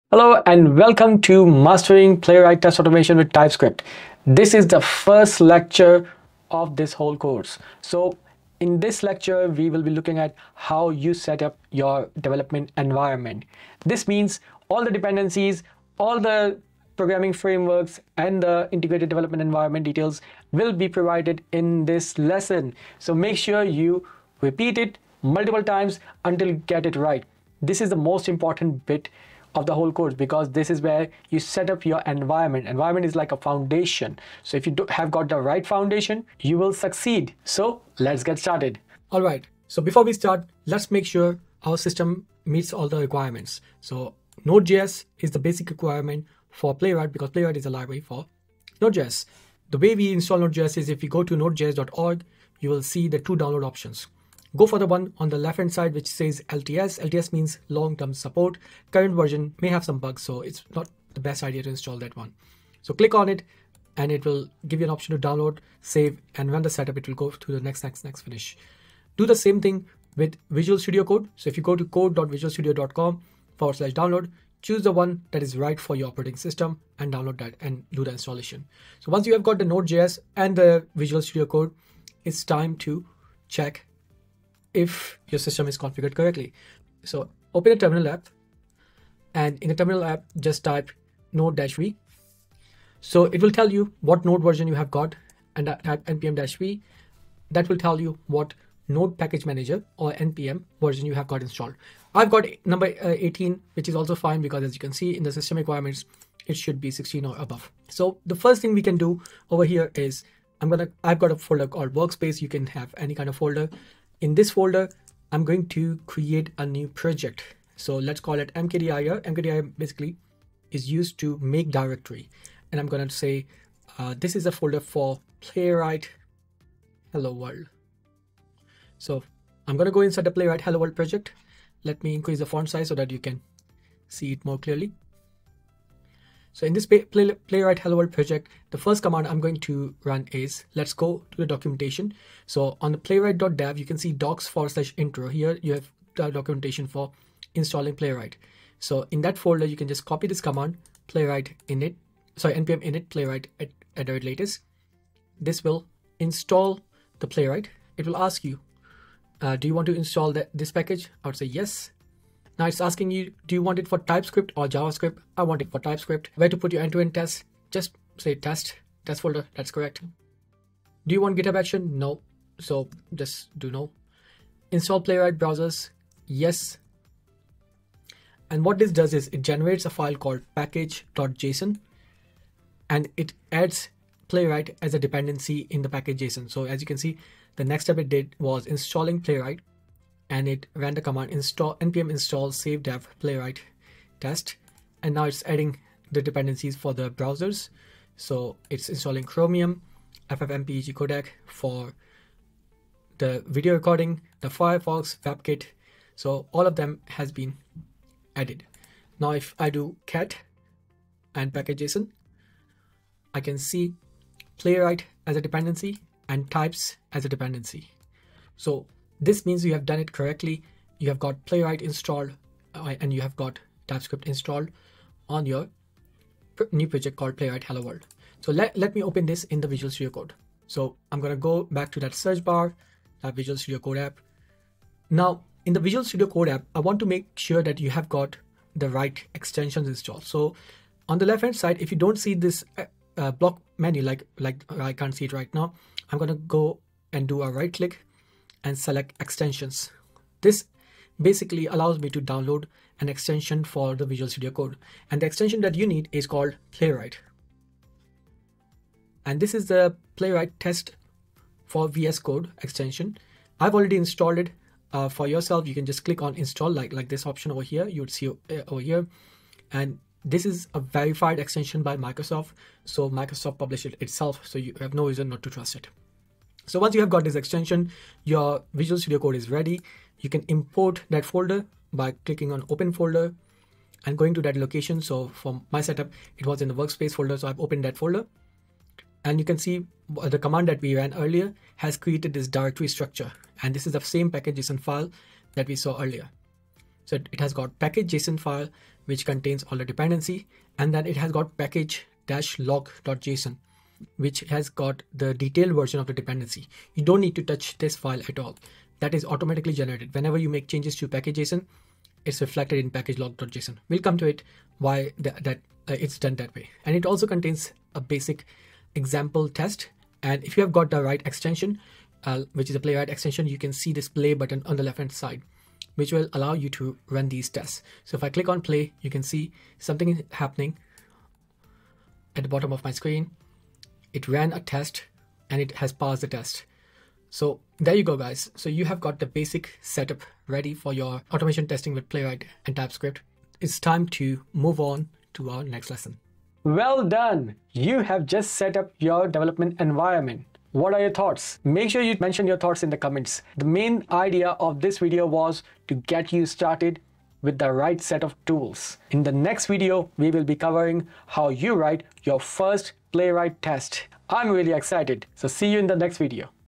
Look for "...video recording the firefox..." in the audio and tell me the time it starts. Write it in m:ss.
3:23.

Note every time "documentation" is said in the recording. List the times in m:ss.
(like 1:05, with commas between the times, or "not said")
2:21, 2:26.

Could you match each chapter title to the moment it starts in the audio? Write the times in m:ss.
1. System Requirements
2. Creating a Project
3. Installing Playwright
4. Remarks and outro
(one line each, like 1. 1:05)
1. 0:43
2. 1:28
3. 2:25
4. 5:47.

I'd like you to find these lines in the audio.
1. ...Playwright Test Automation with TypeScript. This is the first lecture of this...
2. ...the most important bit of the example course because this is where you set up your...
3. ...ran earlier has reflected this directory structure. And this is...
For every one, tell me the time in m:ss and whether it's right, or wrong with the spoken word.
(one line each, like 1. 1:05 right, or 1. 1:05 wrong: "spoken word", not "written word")
1. 0:02 right
2. 0:27 wrong: "whole", not "example"
3. 4:50 wrong: "created", not "reflected".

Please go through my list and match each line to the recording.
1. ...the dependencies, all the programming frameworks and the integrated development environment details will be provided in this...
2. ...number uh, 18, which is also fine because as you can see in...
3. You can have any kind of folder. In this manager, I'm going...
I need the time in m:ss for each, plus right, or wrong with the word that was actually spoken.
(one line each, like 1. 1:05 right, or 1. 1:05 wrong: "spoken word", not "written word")
1. 0:14 right
2. 1:42 right
3. 1:52 wrong: "folder", not "manager".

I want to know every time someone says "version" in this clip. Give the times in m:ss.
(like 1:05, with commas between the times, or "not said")
0:59, 1:34, 1:40, 5:05.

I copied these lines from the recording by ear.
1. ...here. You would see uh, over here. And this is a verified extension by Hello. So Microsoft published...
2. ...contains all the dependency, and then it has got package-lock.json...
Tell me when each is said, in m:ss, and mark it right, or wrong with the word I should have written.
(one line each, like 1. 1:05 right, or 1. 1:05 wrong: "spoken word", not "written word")
1. 4:27 wrong: "Microsoft", not "Hello"
2. 4:59 right.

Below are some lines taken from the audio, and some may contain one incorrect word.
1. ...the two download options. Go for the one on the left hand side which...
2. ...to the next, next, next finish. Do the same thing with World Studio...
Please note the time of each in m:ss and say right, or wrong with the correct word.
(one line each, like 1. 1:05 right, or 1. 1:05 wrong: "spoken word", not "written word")
1. 0:53 right
2. 1:07 wrong: "Visual", not "World".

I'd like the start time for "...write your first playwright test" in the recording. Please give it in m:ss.
6:01.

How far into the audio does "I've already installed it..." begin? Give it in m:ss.
4:23.